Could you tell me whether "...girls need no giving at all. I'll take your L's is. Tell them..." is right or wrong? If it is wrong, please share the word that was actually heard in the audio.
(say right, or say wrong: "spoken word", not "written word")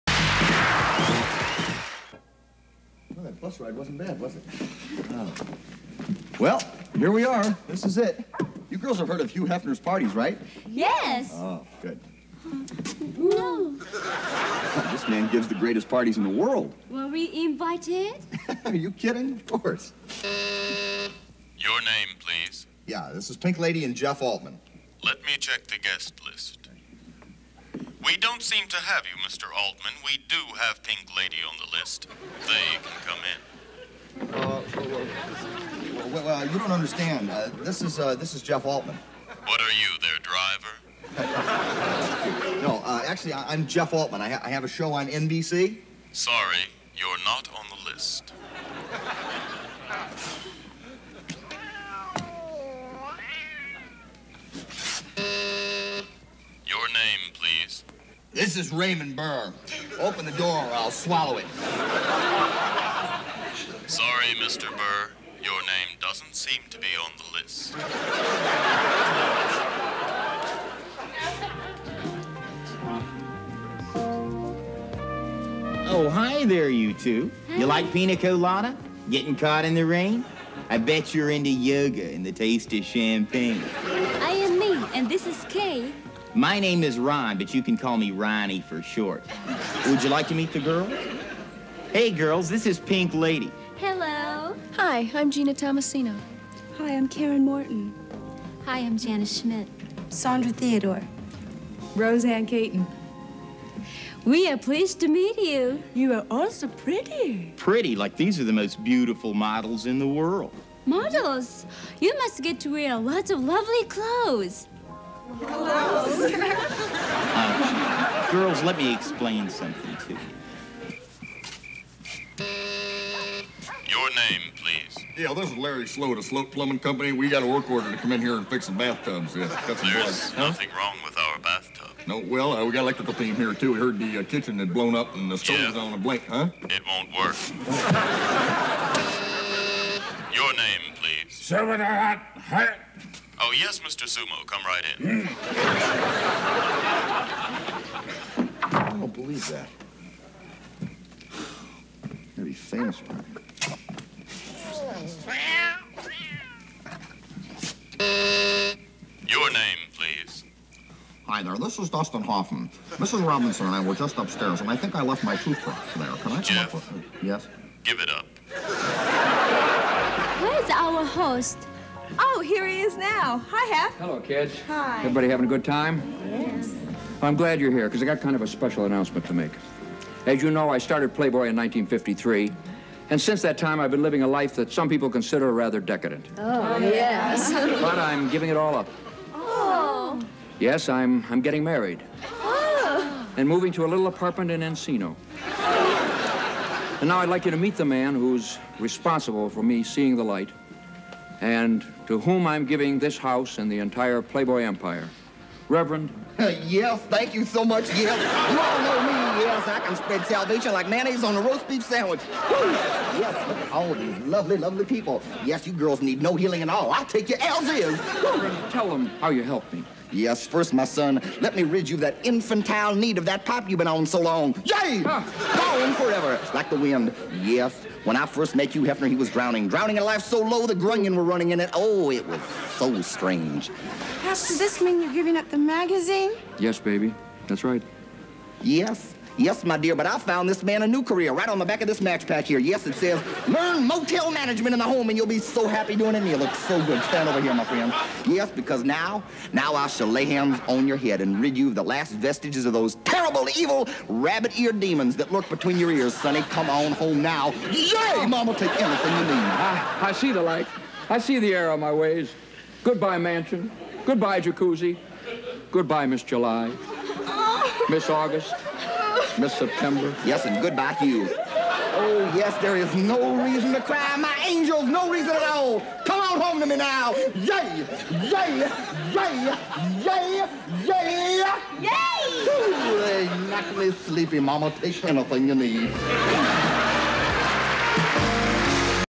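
wrong: "healing", not "giving".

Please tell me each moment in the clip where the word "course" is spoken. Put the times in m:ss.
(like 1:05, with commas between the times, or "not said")
0:19.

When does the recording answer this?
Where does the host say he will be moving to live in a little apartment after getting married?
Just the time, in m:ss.
3:14.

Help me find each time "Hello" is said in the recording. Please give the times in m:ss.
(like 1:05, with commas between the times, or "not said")
1:33, 2:53.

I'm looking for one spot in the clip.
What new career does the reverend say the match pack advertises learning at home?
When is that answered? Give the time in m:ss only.
4:03.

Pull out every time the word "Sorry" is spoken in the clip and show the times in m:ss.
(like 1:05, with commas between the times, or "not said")
0:46, 1:03.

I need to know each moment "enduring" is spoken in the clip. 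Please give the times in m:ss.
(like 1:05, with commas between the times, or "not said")
not said.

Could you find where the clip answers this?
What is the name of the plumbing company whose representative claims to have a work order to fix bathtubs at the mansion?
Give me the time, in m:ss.
2:06.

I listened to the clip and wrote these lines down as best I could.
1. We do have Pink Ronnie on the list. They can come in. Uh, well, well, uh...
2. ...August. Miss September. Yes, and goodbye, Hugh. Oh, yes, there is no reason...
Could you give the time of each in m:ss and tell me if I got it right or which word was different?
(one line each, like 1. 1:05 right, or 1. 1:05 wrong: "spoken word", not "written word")
1. 0:30 wrong: "Lady", not "Ronnie"
2. 4:28 right.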